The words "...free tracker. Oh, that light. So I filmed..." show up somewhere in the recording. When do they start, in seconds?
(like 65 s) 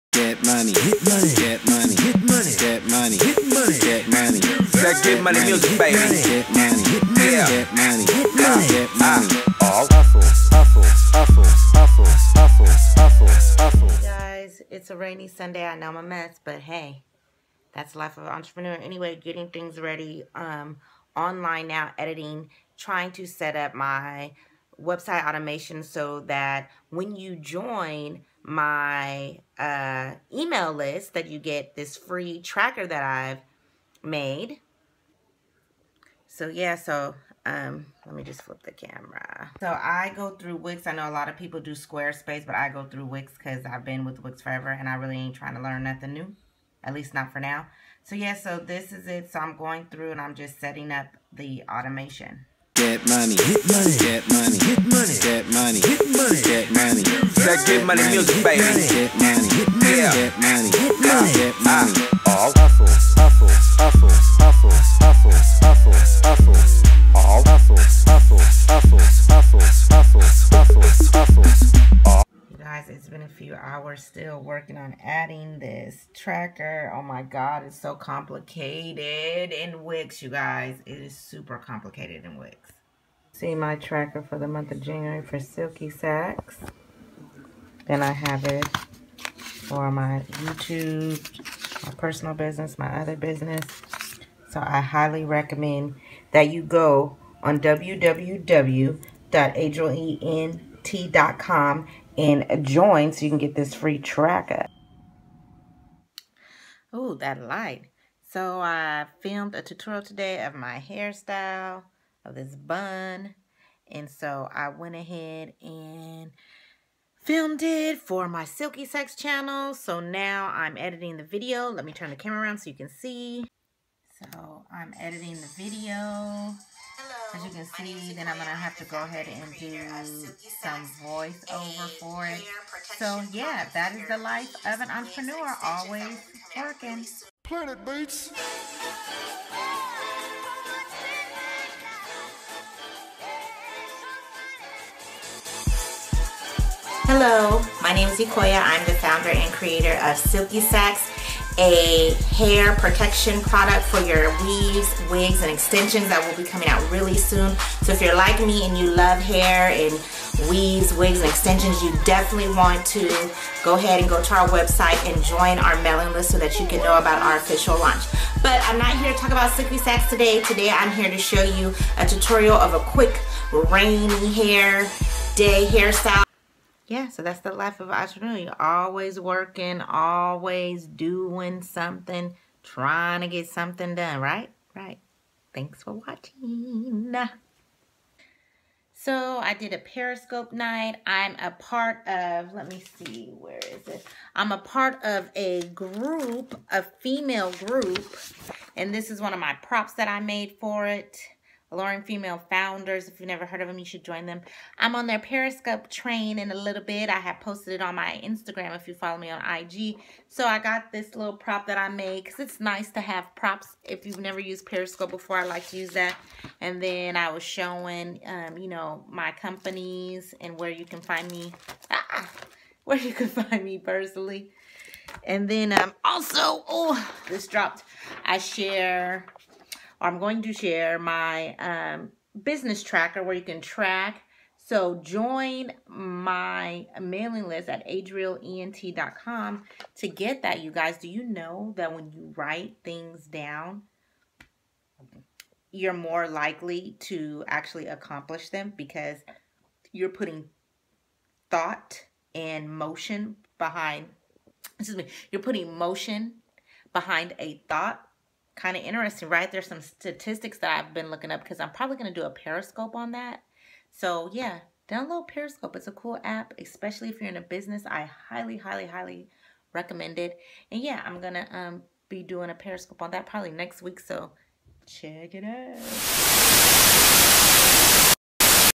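103 s.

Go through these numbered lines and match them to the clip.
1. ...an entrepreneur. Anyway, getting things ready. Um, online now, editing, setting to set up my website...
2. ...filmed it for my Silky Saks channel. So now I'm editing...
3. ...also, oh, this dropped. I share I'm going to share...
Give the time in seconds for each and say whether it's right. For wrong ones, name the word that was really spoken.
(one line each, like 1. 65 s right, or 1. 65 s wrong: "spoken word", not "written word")
1. 18 s wrong: "trying", not "setting"
2. 117 s right
3. 226 s right.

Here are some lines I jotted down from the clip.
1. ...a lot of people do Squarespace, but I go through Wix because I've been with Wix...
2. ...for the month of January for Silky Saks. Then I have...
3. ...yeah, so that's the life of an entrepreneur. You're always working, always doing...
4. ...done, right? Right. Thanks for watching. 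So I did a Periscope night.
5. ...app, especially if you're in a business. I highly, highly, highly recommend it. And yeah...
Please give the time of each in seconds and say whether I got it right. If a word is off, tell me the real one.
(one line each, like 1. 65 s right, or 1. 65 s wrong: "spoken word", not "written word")
1. 41 s right
2. 84 s right
3. 176 s right
4. 183 s right
5. 266 s right.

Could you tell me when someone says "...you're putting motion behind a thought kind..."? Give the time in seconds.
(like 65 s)
255 s.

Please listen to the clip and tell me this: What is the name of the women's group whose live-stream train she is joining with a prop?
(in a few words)
Alluring Female Founders.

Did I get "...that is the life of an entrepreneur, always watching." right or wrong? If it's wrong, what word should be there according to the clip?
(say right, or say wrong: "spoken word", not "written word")
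wrong: "working", not "watching".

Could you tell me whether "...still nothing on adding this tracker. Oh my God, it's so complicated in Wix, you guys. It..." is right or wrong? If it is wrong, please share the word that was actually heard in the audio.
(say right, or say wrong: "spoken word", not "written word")
wrong: "working", not "nothing".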